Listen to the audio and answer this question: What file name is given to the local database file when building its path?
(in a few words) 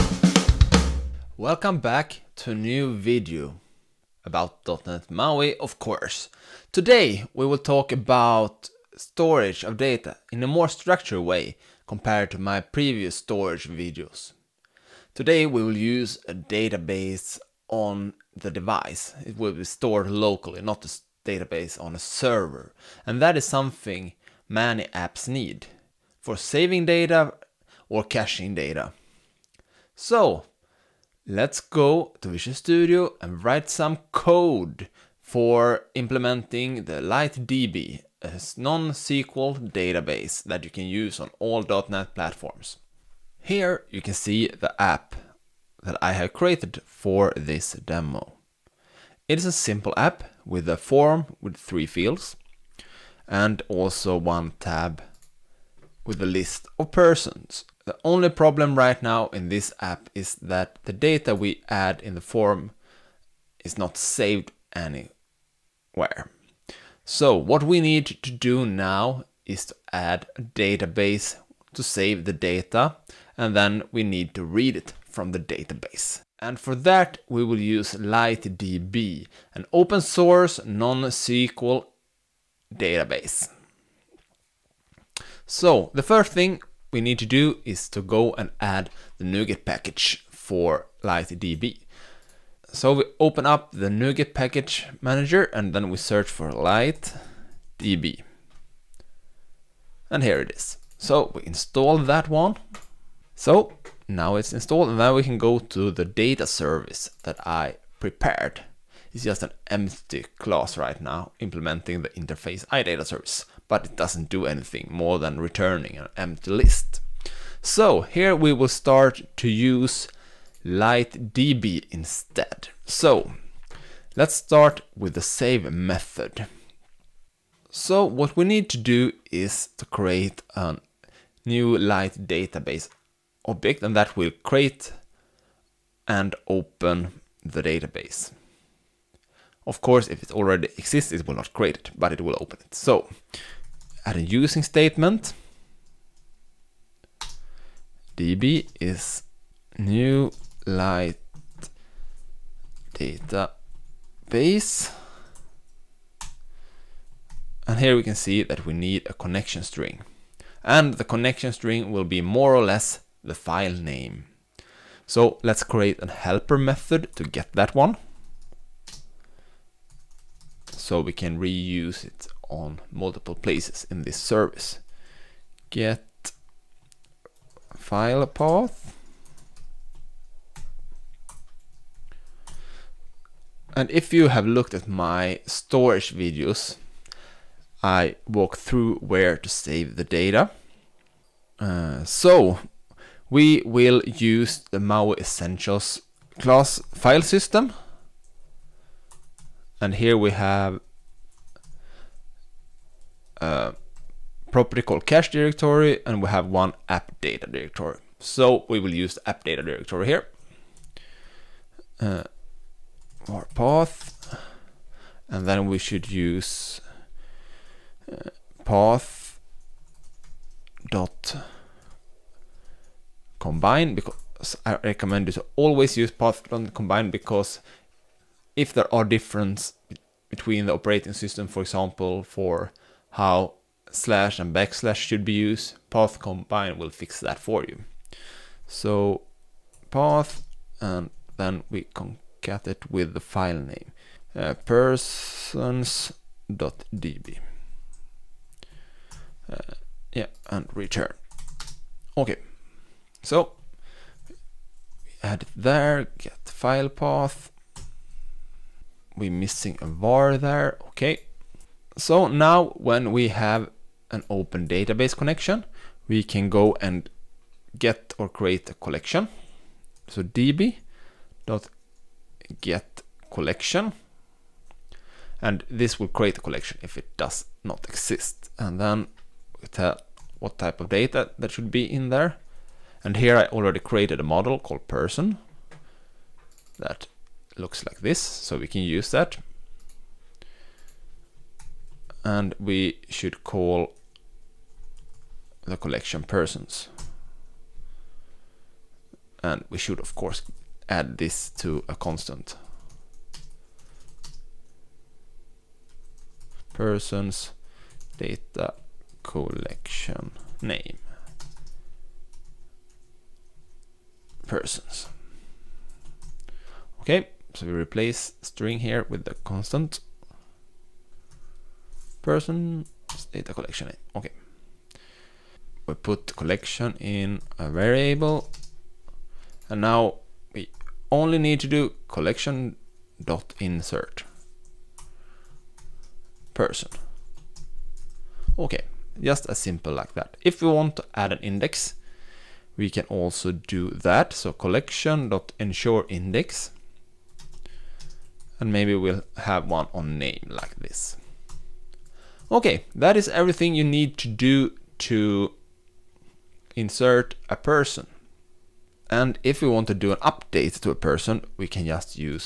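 persons.db.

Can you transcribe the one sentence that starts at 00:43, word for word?
Here you can see the app that I have created for this demo.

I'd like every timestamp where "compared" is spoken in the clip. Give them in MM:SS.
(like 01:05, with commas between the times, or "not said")
00:11.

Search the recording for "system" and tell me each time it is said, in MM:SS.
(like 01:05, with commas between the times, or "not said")
03:17, 03:51.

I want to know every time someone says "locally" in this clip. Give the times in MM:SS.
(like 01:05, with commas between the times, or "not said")
00:20.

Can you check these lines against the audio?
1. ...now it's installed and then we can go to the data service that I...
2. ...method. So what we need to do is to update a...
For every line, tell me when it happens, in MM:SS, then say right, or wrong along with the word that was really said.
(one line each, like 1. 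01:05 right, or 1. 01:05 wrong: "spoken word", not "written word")
1. 01:44 right
2. 02:05 wrong: "create", not "update".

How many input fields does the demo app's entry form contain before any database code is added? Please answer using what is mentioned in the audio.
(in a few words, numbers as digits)
3.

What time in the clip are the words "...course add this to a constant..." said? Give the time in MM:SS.
05:00.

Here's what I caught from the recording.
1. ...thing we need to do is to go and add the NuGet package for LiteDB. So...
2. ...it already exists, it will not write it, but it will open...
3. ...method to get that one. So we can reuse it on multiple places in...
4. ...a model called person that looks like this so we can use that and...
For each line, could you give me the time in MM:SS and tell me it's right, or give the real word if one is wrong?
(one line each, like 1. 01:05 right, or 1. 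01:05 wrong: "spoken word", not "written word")
1. 01:26 right
2. 02:20 wrong: "create", not "write"
3. 02:46 right
4. 04:44 right.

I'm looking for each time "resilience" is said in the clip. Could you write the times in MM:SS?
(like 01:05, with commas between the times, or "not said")
not said.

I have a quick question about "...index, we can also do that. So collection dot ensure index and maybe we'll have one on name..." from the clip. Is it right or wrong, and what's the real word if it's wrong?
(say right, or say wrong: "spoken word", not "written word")
right.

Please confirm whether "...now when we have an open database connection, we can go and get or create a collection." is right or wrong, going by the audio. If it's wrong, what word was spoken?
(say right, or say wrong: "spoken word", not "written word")
right.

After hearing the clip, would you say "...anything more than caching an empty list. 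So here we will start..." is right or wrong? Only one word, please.
wrong.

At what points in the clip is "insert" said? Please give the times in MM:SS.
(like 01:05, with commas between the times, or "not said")
05:33, 05:56.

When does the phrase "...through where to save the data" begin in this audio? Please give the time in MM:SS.
03:08.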